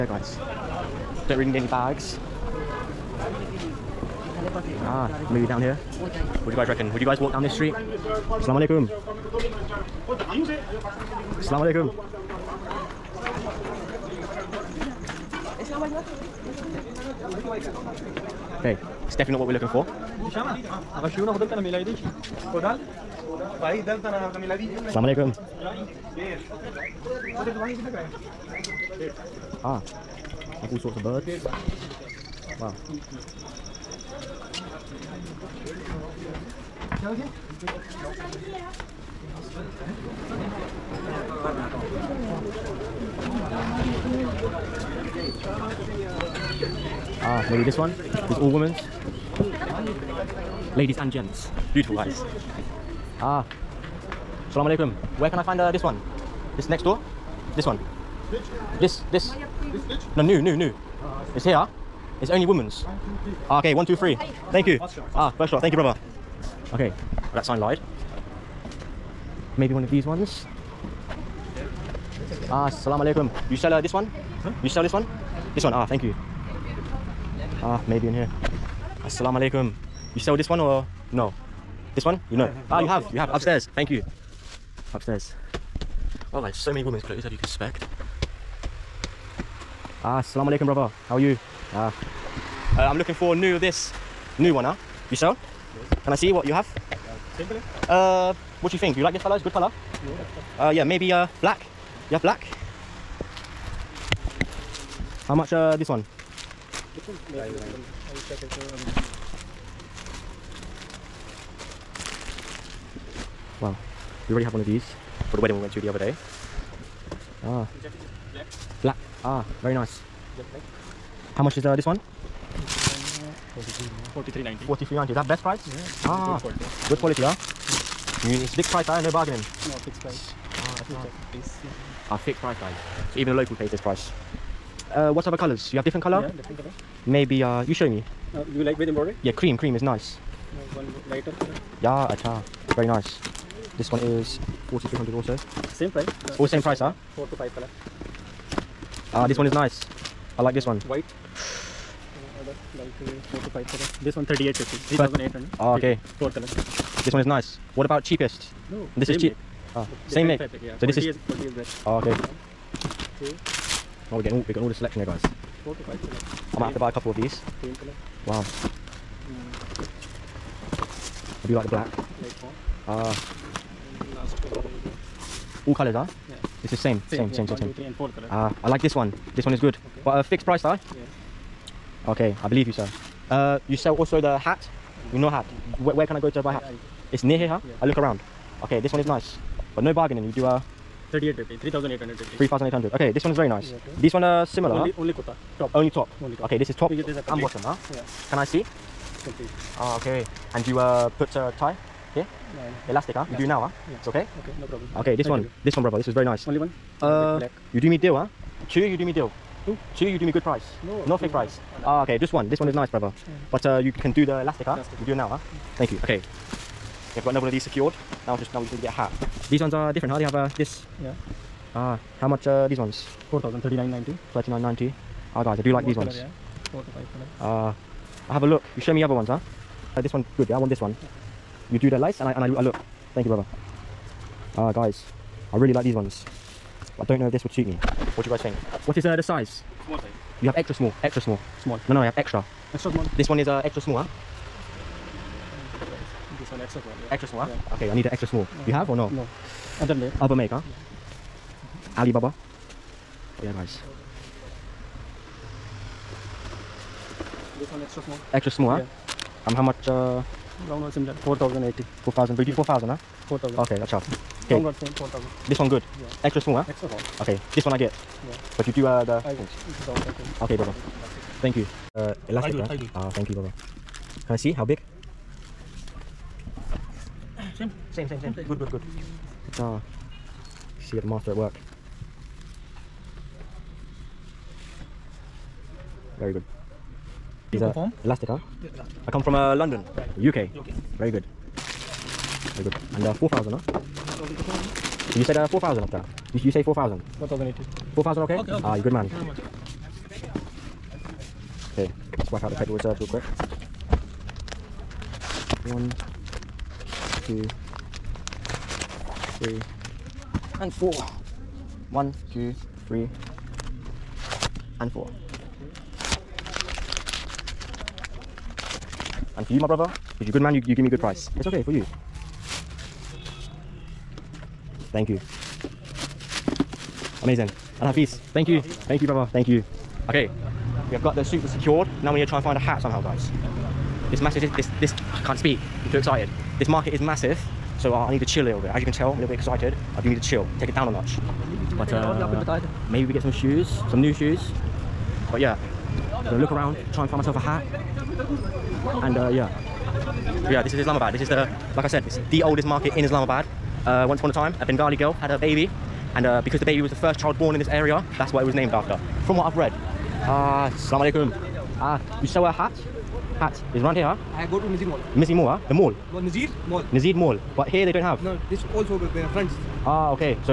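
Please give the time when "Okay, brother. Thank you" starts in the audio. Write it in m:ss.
4:30.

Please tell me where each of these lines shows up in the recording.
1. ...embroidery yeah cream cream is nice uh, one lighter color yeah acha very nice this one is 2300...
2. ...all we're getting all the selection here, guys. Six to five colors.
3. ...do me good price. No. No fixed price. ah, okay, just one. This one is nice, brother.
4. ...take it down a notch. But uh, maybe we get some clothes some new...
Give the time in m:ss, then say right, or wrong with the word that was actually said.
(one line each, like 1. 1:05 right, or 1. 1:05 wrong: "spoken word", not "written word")
1. 2:18 wrong: "4300", not "2300"
2. 2:44 wrong: "Four", not "Six"
3. 3:30 right
4. 5:40 wrong: "shoes", not "clothes".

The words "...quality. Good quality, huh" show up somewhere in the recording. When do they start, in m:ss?
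2:06.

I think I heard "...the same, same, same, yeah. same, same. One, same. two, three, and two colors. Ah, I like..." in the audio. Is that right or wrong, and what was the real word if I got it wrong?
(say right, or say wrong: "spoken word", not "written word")
wrong: "four", not "two".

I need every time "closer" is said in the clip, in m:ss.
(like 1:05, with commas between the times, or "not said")
not said.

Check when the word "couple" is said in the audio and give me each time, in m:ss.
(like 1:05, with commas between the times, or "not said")
2:46.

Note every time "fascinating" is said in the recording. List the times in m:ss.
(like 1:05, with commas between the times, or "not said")
not said.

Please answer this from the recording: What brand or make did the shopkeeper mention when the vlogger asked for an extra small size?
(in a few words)
Alibaba.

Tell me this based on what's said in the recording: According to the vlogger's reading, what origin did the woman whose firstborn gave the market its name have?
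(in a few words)
Bengali.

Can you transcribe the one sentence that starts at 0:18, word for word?
Okay, it's definitely not what we're looking for.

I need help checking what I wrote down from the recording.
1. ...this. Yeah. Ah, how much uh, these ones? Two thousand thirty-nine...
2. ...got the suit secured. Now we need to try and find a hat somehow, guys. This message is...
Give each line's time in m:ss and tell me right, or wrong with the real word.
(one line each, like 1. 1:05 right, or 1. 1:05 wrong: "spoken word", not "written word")
1. 3:40 wrong: "Four", not "Two"
2. 5:31 right.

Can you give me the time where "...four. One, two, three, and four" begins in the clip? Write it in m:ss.
5:10.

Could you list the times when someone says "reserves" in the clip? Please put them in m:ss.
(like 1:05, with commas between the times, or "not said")
5:02.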